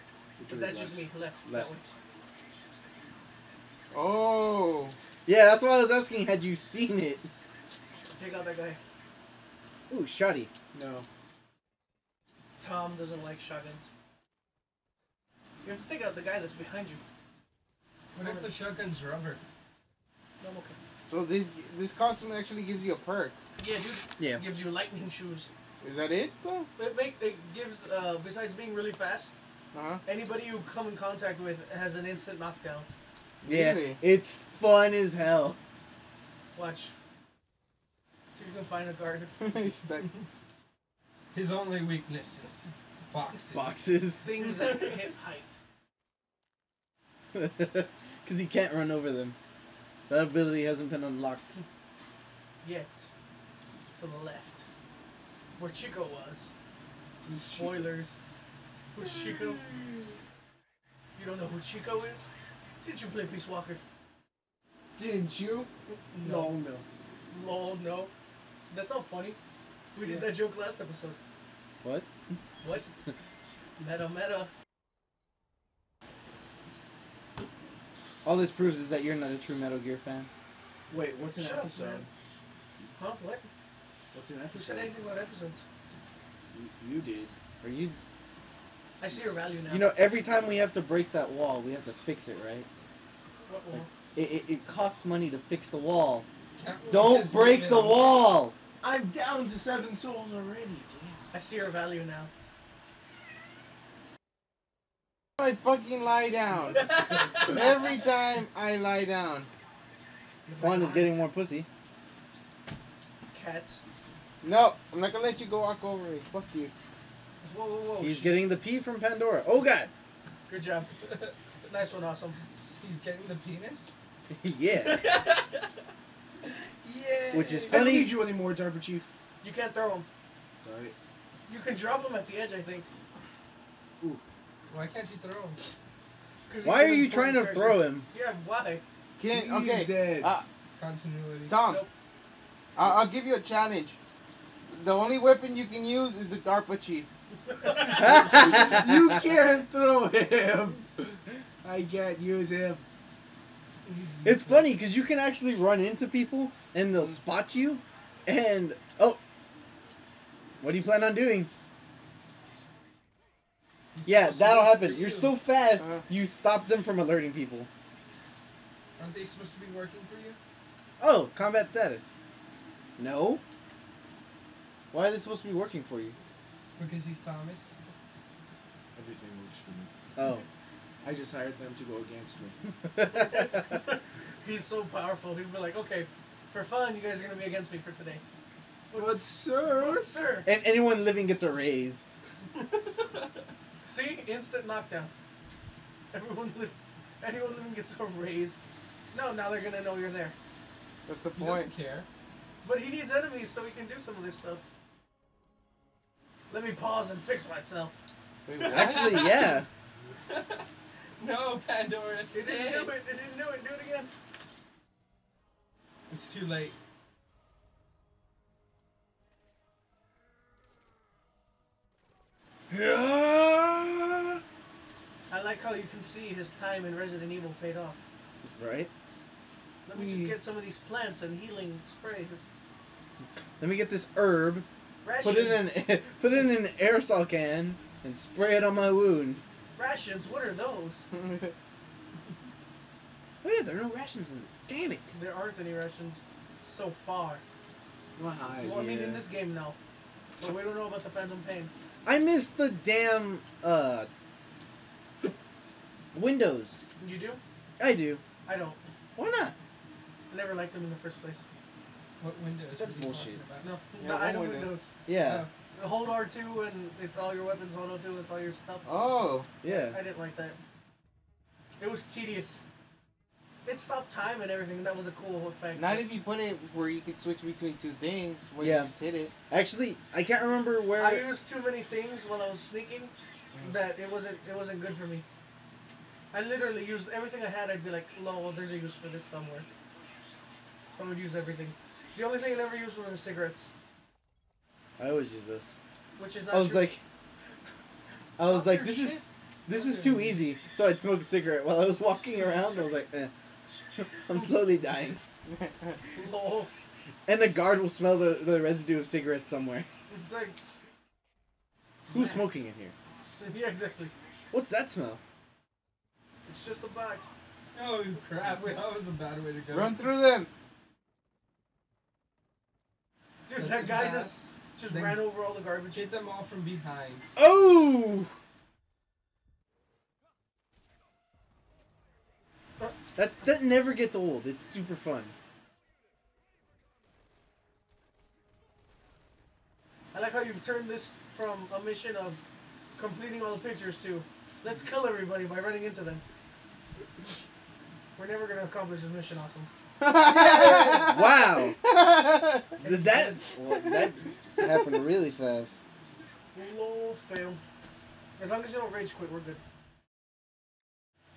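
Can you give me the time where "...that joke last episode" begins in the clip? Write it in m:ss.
1:10.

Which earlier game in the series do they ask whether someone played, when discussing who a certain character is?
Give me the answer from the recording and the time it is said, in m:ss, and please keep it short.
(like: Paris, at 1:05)
Peace Walker, at 1:03.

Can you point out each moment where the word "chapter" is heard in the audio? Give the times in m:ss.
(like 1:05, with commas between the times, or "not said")
not said.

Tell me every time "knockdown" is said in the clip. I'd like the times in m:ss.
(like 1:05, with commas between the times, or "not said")
0:32, 3:14.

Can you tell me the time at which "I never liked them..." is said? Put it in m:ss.
4:20.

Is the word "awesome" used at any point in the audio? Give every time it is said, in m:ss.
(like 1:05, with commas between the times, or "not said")
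2:02, 5:49.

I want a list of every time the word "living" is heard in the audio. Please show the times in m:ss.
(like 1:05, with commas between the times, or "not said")
3:11, 3:17.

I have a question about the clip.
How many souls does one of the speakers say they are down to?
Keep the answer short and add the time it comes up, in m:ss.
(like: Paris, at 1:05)
7, at 1:39.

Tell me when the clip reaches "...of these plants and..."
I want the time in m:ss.
3:50.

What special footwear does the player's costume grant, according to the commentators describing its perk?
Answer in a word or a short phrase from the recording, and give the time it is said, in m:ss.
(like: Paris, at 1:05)
Lightning shoes, at 0:24.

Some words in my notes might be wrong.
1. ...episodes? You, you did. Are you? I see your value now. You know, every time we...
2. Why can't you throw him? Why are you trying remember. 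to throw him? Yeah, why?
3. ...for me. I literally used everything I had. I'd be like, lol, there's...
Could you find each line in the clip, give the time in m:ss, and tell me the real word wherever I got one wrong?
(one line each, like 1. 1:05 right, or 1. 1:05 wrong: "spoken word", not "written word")
1. 1:25 right
2. 2:14 wrong: "character", not "remember"
3. 4:44 right.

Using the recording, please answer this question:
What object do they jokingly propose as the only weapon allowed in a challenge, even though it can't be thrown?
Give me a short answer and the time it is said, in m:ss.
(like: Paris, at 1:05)
The DARPA chief, at 2:26.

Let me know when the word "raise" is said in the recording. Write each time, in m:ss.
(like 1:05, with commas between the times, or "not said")
3:11, 3:18.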